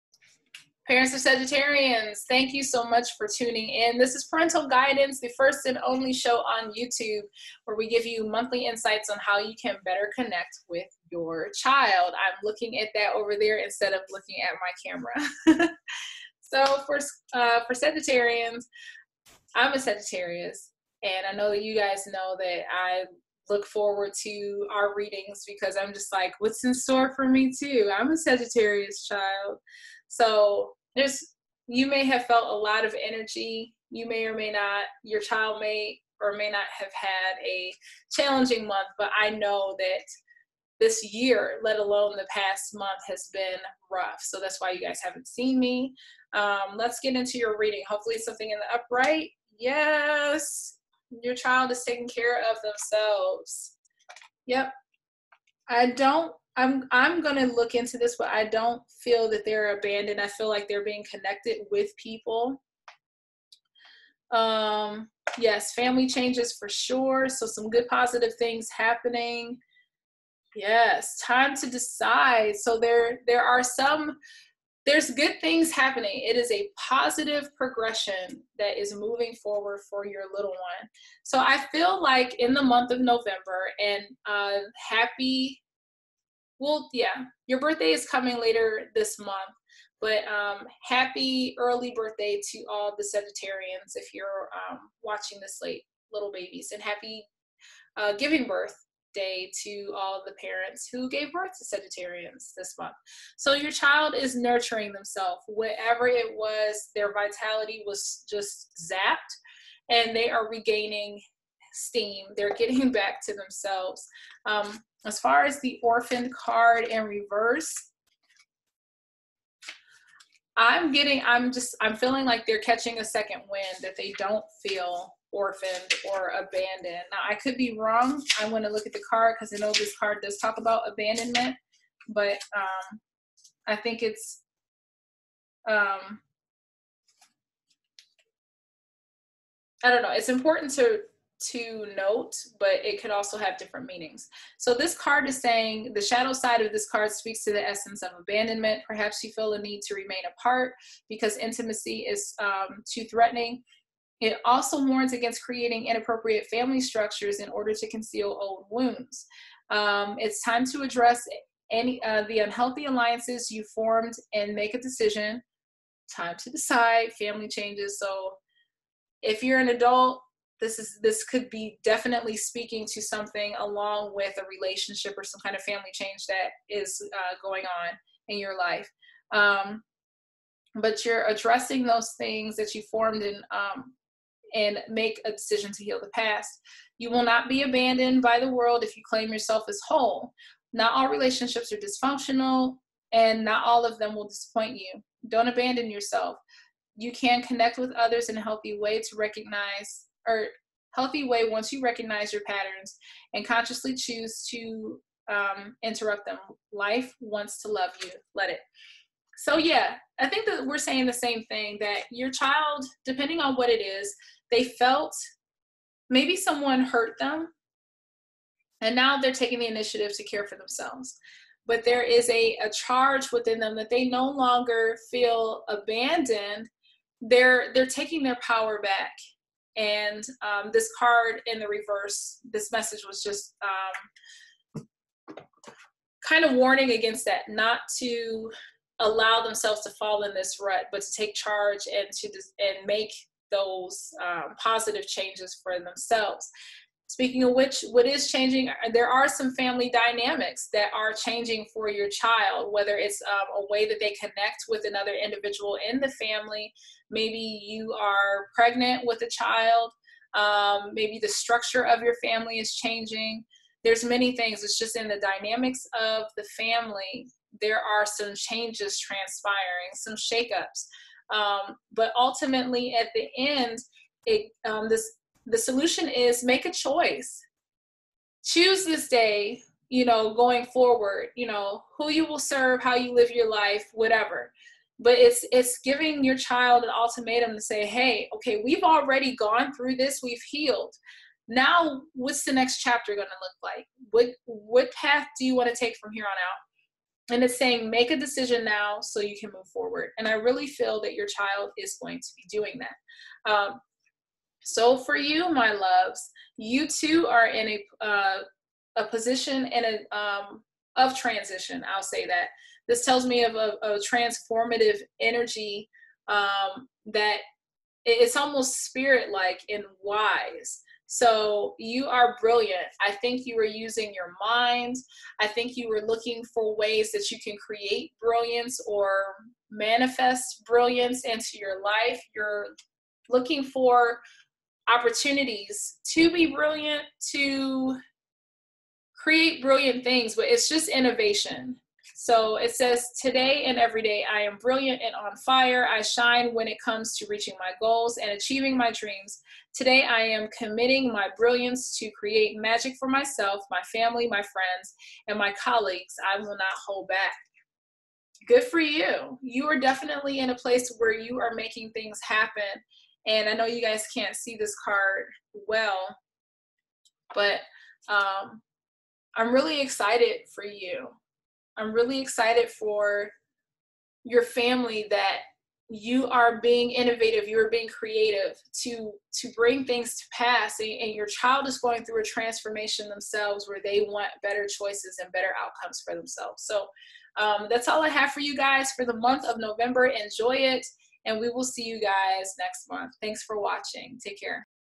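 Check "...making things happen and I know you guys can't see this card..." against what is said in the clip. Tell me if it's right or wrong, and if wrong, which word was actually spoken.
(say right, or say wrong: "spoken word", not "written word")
right.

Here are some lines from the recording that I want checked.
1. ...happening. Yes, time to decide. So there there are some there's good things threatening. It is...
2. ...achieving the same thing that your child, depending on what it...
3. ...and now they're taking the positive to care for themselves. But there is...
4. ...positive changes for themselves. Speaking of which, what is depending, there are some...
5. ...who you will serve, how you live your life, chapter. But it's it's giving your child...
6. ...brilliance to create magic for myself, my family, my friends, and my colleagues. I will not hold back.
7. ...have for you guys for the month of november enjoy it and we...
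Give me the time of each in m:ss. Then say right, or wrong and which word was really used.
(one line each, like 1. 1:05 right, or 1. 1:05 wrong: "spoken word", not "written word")
1. 1:08 wrong: "happening", not "threatening"
2. 3:30 wrong: "saying", not "achieving"
3. 3:38 wrong: "initiative", not "positive"
4. 4:04 wrong: "changing", not "depending"
5. 4:41 wrong: "whatever", not "chapter"
6. 5:51 right
7. 6:28 right.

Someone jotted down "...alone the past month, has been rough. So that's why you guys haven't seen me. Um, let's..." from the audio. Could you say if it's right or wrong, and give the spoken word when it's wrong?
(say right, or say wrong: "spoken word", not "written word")
right.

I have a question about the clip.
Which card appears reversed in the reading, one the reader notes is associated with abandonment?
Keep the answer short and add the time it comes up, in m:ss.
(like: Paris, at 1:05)
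The orphan card, at 1:55.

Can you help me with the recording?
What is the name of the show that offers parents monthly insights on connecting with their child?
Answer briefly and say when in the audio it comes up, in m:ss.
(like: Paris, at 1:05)
Parental Guidance, at 0:04.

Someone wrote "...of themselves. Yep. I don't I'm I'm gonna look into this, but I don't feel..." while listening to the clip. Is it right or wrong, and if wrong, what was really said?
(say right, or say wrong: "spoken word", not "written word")
right.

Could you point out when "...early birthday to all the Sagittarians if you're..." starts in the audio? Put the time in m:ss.
1:31.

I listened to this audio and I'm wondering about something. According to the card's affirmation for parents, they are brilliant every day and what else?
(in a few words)
On fire.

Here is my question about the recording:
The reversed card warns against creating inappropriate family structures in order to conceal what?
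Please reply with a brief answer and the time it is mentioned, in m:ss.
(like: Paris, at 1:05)
Old wounds, at 2:38.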